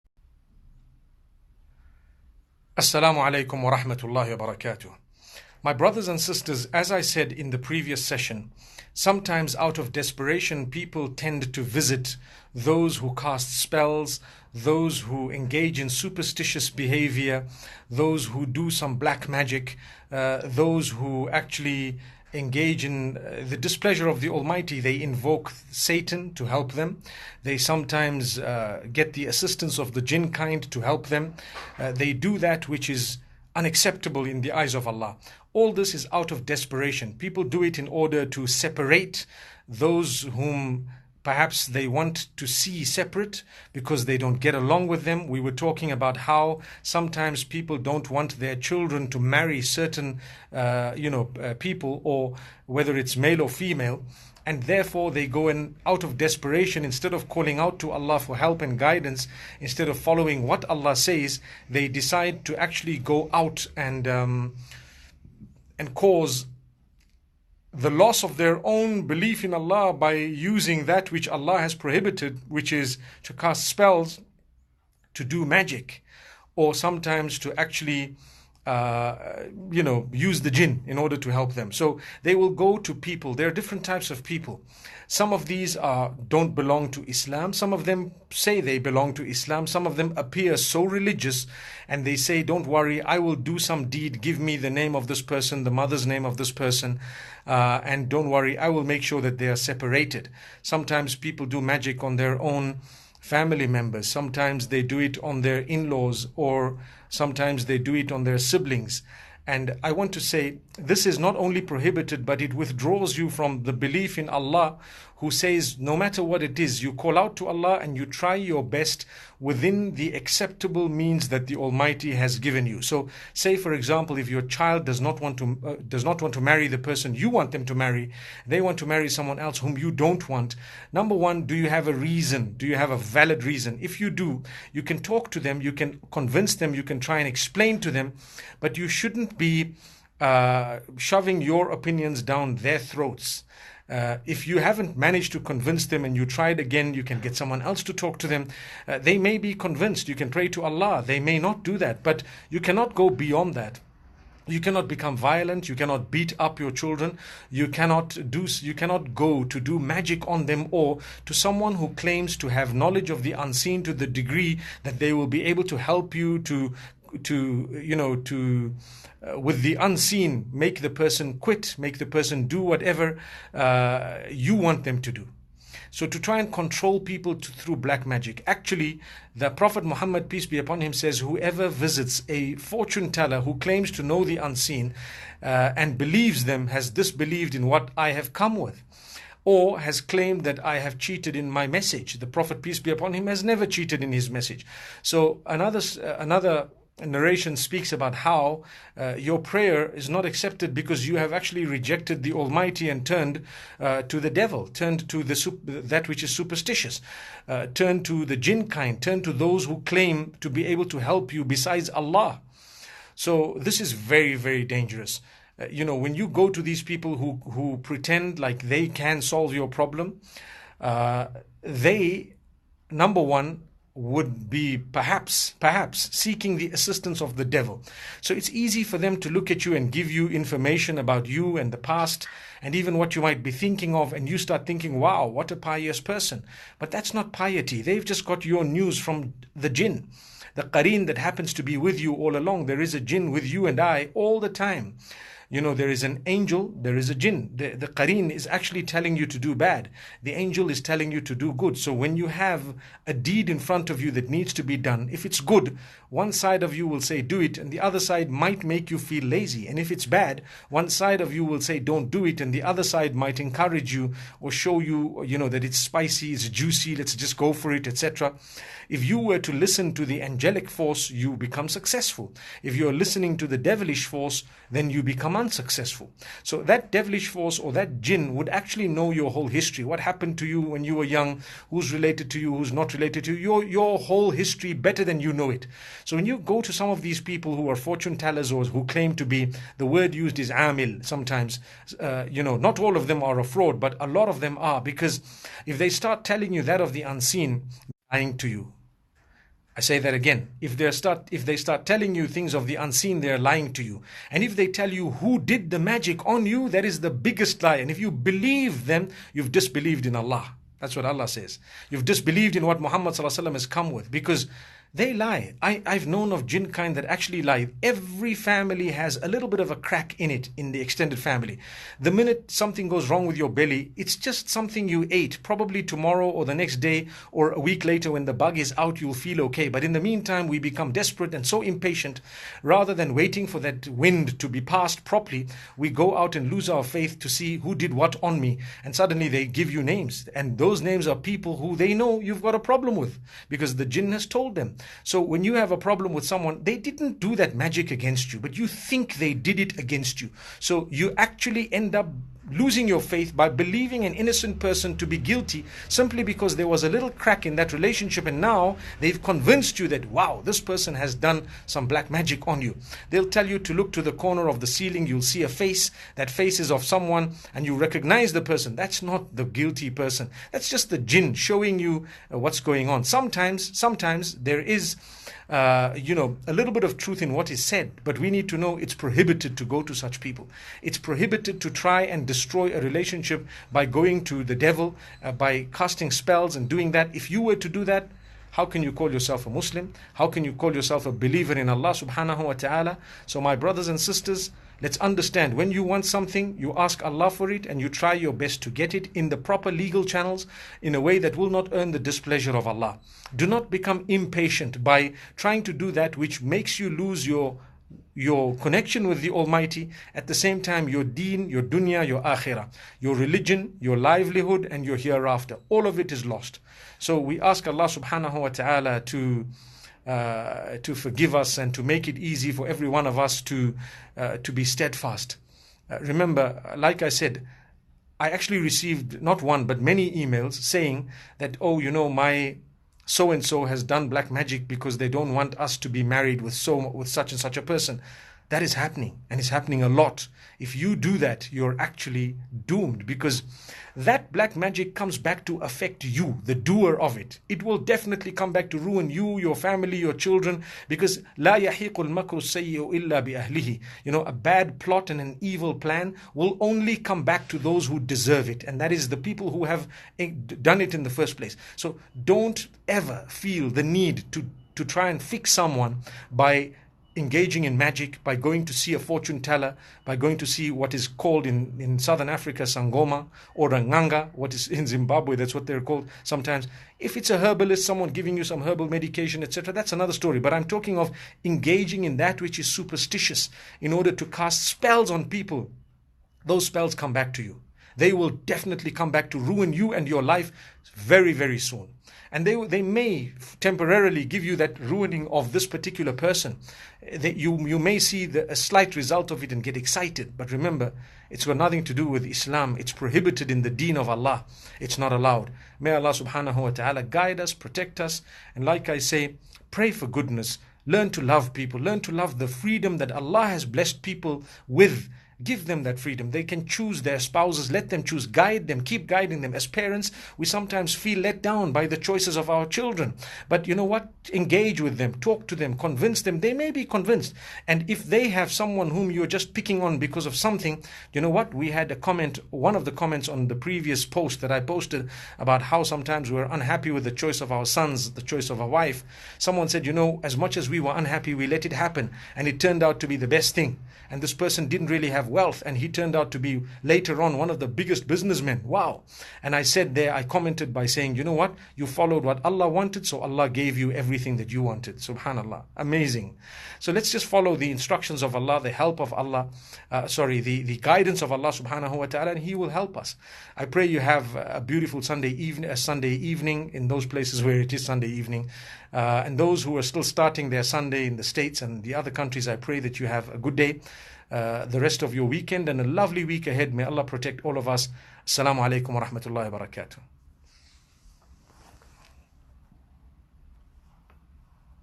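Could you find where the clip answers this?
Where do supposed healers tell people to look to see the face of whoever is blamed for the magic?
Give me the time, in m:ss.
6:04.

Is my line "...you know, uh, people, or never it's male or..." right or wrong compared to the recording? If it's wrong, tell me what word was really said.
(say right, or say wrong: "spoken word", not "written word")
wrong: "whether", not "never".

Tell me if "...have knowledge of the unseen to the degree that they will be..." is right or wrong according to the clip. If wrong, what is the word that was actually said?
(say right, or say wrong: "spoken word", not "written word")
right.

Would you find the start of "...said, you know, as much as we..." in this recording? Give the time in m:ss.
8:59.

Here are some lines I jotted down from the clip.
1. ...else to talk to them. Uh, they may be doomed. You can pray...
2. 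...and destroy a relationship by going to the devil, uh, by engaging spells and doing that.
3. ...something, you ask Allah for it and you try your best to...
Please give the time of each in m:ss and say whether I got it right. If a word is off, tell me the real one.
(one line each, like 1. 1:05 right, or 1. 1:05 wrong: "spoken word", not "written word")
1. 2:27 wrong: "convinced", not "doomed"
2. 6:22 wrong: "casting", not "engaging"
3. 6:36 right.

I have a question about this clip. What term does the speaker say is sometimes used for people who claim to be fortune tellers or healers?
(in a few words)
amil.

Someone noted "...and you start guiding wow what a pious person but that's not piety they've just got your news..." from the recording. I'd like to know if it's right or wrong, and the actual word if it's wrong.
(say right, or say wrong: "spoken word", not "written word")
wrong: "thinking", not "guiding".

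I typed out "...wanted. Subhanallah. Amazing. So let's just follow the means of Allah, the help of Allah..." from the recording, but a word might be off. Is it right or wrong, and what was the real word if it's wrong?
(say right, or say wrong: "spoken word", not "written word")
wrong: "instructions", not "means".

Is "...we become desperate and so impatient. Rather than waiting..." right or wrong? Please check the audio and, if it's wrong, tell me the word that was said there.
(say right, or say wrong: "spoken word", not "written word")
right.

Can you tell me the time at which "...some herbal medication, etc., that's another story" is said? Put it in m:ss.
7:58.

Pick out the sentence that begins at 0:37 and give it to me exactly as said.
People do it in order to separate those whom perhaps they want to see separate because they don't get along with them.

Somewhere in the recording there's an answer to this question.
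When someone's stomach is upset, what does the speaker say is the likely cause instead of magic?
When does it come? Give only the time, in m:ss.
5:24.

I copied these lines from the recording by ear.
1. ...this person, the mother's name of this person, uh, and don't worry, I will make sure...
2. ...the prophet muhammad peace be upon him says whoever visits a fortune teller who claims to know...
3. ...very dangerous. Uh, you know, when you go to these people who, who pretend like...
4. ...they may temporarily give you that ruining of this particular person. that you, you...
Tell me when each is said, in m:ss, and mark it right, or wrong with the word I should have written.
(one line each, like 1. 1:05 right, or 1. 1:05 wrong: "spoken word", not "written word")
1. 1:35 right
2. 2:59 right
3. 3:34 right
4. 8:12 right.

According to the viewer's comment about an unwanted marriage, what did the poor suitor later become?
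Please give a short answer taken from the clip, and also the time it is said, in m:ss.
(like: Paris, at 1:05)
one of the biggest businessmen, at 9:07.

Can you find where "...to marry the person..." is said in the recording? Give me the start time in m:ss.
2:06.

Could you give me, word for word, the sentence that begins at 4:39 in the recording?
What happened to you when you were young?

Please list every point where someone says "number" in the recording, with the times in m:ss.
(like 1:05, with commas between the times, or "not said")
2:10, 3:42.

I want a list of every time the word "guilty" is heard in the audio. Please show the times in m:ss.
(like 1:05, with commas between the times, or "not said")
5:55, 6:09.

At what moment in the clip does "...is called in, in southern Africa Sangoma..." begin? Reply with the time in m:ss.
7:50.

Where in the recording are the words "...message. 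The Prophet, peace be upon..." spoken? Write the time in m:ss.
3:11.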